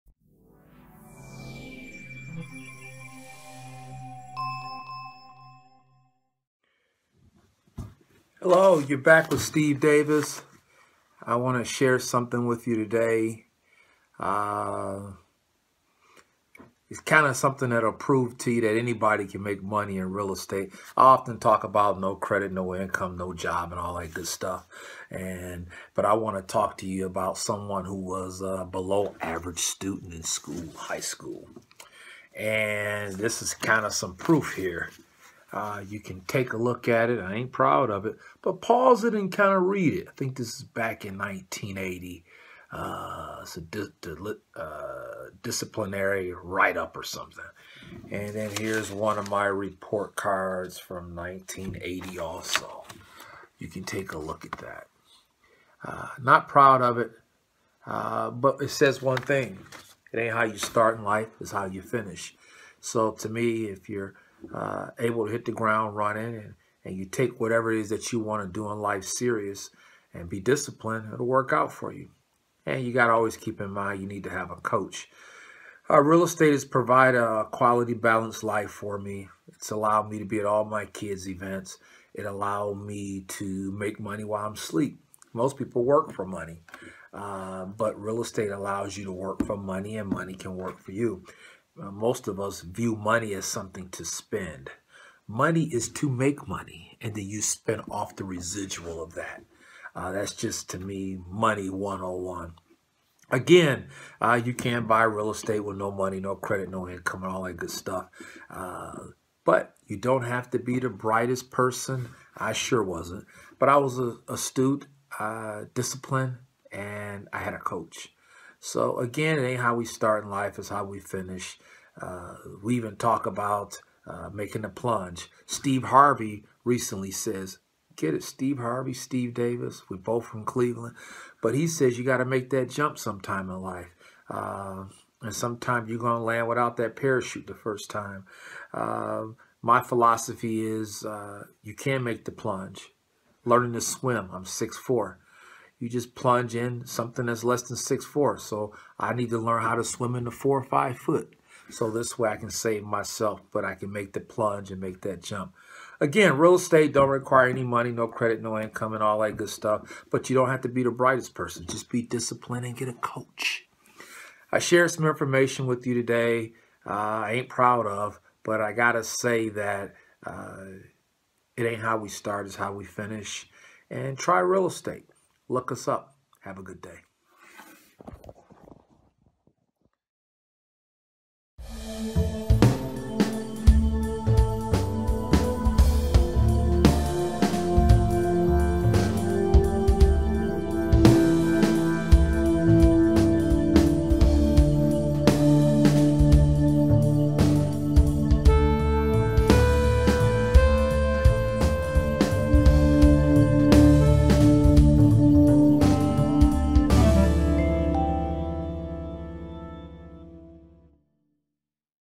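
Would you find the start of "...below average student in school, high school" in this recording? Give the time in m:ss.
0:28.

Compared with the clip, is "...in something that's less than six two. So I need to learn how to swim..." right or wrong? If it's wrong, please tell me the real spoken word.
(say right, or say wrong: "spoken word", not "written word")
wrong: "four", not "two".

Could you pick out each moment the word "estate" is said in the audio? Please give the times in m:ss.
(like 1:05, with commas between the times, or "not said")
0:20, 1:16, 1:28, 1:45, 2:36, 2:54.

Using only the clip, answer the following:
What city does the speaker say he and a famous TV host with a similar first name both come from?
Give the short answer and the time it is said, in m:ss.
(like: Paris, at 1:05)
Cleveland, at 2:10.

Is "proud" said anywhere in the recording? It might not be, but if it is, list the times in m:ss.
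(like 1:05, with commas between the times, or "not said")
0:37, 0:56, 2:47.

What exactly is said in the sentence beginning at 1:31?
Uh, most of us view money as something to spend.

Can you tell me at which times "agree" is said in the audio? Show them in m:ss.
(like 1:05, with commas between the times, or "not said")
not said.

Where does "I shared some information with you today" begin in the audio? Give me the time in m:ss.
2:44.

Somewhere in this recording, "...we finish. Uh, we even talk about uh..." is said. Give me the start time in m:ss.
2:00.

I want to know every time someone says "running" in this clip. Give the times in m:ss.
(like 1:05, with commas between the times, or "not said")
1:05.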